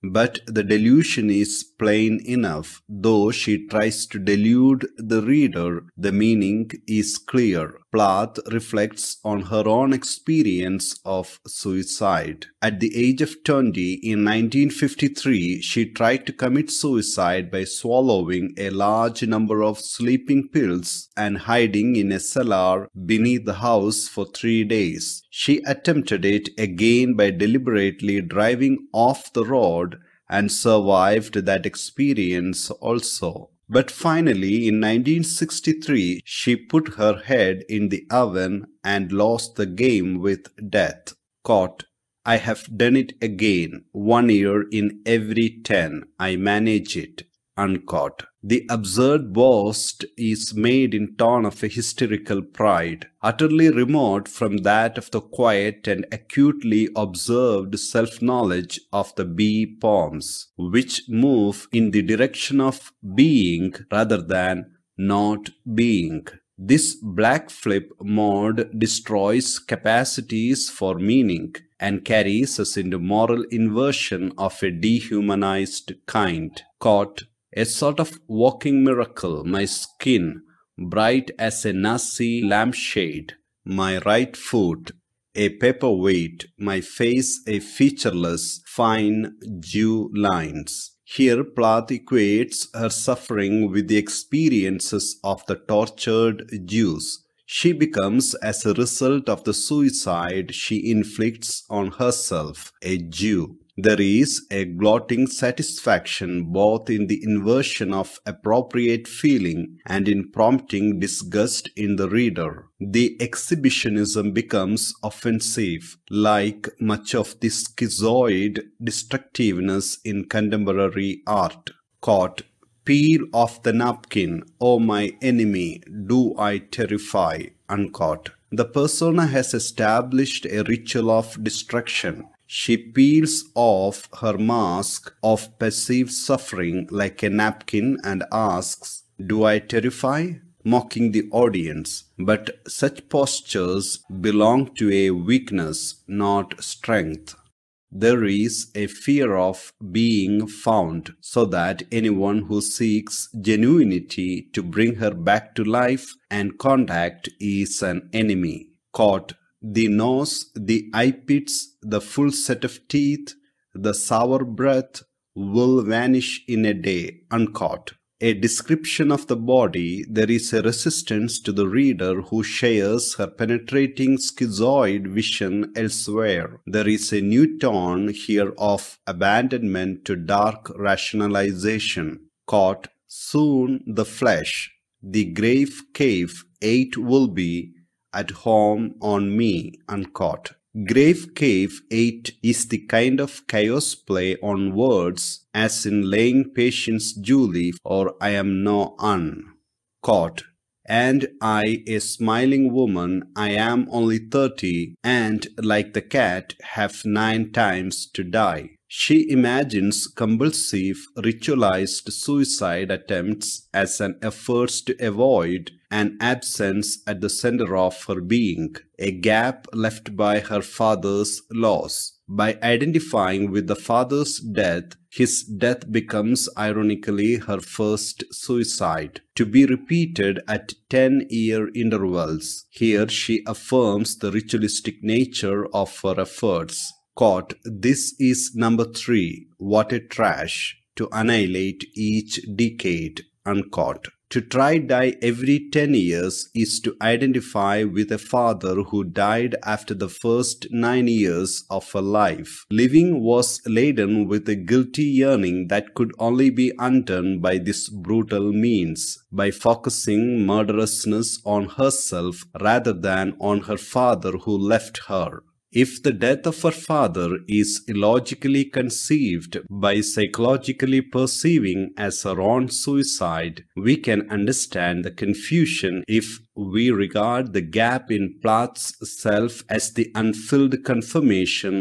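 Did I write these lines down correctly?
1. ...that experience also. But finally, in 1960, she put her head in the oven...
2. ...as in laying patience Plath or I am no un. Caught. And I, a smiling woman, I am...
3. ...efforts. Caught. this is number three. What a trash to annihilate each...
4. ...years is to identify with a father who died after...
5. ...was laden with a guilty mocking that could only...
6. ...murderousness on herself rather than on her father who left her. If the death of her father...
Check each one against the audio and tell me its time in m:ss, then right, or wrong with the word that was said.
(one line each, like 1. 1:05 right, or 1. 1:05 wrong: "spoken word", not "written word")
1. 0:31 wrong: "1963", not "1960"
2. 3:15 wrong: "Julie", not "Plath"
3. 3:56 right
4. 4:05 right
5. 4:13 wrong: "yearning", not "mocking"
6. 4:20 right.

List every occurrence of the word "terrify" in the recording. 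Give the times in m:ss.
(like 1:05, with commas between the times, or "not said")
2:06, 2:19.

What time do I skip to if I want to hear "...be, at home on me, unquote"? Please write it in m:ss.
3:07.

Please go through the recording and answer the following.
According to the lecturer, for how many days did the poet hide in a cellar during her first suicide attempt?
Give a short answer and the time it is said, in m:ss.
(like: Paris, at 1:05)
3, at 0:24.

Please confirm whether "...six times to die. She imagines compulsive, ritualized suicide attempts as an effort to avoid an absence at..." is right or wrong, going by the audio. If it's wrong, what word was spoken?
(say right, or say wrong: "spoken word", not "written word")
wrong: "nine", not "six".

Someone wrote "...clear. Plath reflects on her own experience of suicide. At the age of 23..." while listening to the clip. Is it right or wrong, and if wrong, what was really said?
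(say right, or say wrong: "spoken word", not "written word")
wrong: "20", not "23".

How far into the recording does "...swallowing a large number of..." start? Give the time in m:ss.
0:17.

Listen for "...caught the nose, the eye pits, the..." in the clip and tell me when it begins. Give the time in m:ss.
2:38.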